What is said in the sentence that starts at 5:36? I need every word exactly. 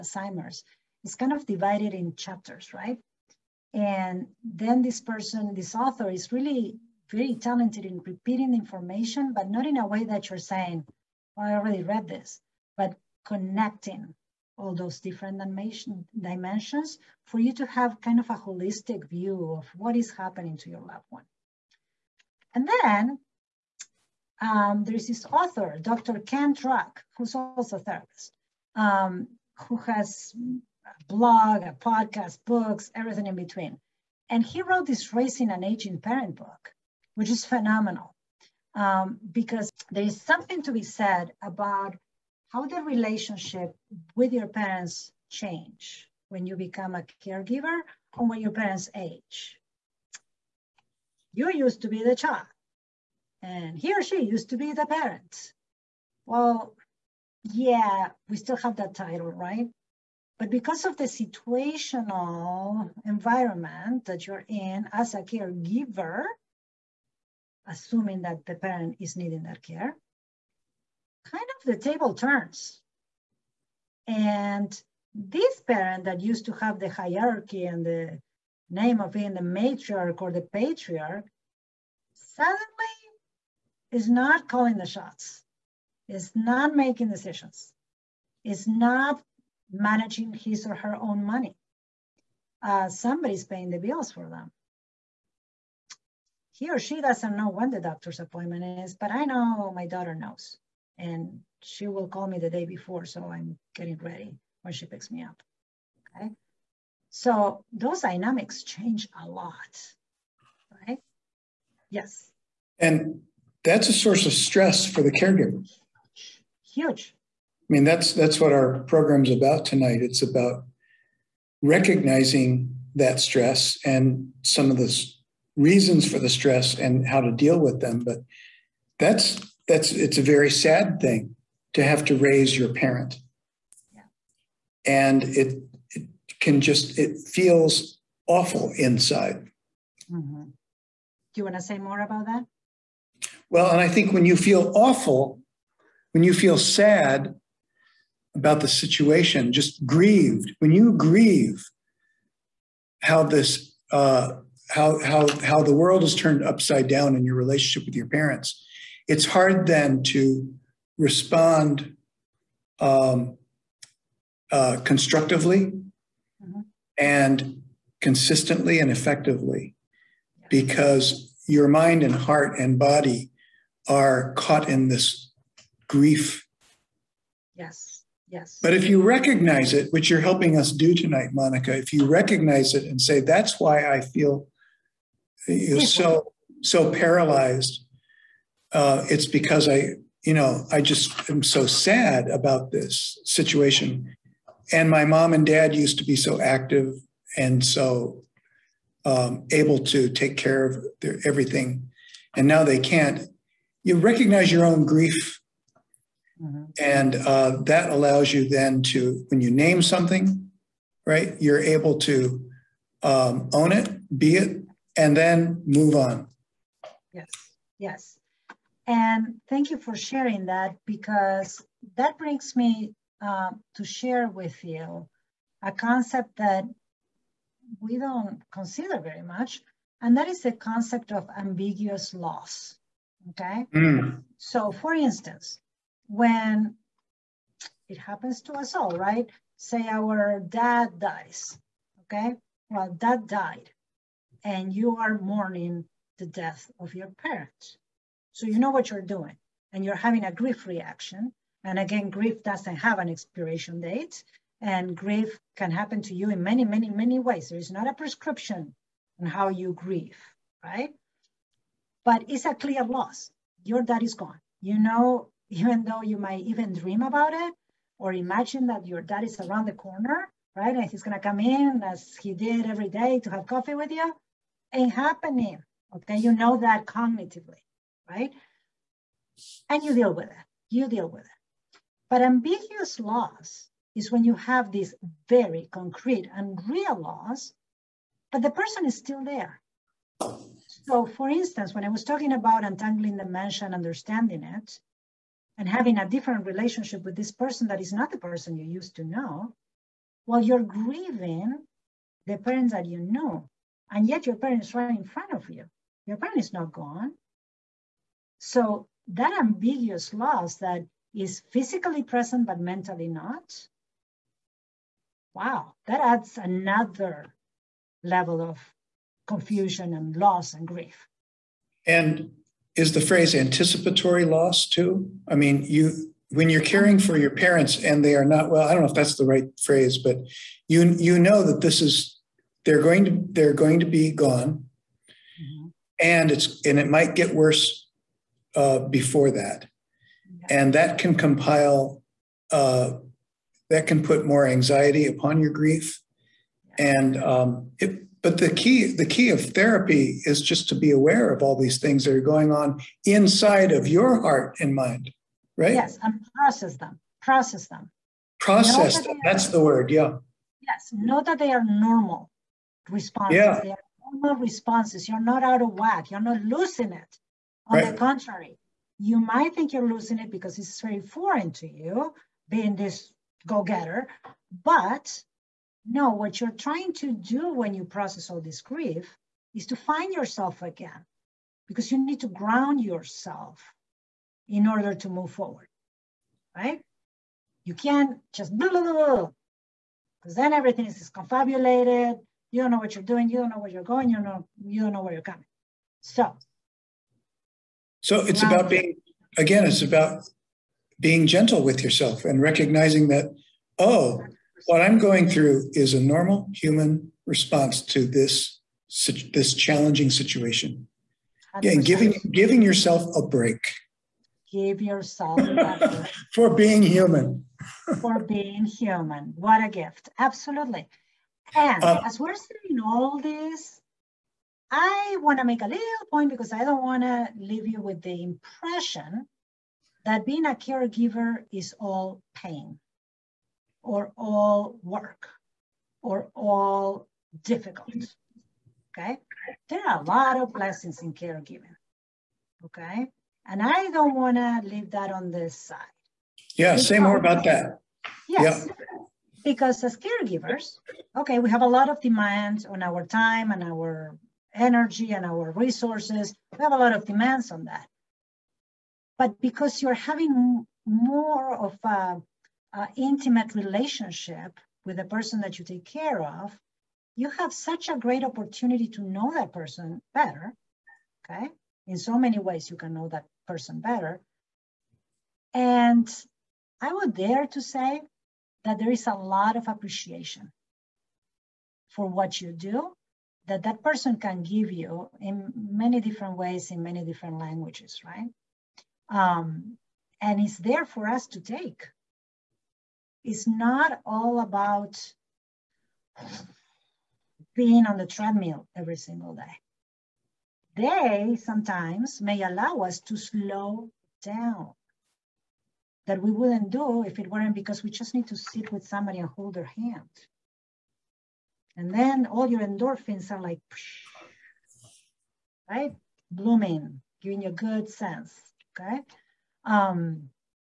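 and it's and it might get worse uh, before that, and that can compile.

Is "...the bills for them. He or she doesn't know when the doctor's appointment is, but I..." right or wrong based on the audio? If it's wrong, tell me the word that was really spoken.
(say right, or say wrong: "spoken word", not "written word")
right.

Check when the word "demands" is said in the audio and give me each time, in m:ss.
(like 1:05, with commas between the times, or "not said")
7:32, 7:37.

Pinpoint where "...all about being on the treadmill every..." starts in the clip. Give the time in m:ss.
8:14.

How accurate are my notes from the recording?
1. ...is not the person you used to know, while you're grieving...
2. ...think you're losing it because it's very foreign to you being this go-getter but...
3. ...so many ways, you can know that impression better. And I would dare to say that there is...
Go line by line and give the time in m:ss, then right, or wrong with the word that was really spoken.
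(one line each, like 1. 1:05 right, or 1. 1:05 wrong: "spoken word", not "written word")
1. 4:57 right
2. 6:09 right
3. 7:51 wrong: "person", not "impression".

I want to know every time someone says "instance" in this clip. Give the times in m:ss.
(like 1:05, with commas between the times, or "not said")
3:54, 4:51.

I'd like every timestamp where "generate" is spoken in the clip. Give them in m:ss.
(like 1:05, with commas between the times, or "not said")
not said.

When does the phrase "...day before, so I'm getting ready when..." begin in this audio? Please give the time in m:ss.
1:42.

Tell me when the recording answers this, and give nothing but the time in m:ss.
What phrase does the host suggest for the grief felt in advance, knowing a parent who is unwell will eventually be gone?
5:23.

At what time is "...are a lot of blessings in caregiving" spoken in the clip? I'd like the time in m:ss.
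7:19.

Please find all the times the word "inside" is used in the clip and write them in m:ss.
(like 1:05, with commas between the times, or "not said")
2:18, 5:53.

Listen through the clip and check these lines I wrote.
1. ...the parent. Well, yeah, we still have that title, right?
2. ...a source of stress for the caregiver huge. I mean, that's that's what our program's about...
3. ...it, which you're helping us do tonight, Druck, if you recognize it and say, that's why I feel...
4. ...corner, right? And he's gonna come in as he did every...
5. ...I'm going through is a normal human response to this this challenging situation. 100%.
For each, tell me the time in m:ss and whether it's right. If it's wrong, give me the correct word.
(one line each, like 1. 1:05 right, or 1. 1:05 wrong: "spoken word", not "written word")
1. 0:54 right
2. 1:53 right
3. 2:59 wrong: "Monica", not "Druck"
4. 4:29 right
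5. 6:44 right.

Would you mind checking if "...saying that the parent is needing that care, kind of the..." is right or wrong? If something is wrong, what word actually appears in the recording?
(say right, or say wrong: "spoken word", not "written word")
wrong: "assuming", not "saying".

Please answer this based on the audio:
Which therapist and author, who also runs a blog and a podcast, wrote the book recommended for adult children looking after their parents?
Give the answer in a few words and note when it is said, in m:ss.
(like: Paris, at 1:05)
Dr. Ken Druck, at 0:25.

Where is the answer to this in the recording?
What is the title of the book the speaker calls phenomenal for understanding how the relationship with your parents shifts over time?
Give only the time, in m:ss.
0:35.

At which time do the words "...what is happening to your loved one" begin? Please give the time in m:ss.
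0:19.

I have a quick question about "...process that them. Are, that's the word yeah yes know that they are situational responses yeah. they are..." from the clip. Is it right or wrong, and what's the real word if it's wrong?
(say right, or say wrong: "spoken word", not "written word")
wrong: "normal", not "situational".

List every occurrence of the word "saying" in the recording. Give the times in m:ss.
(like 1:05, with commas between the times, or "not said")
0:10, 7:02.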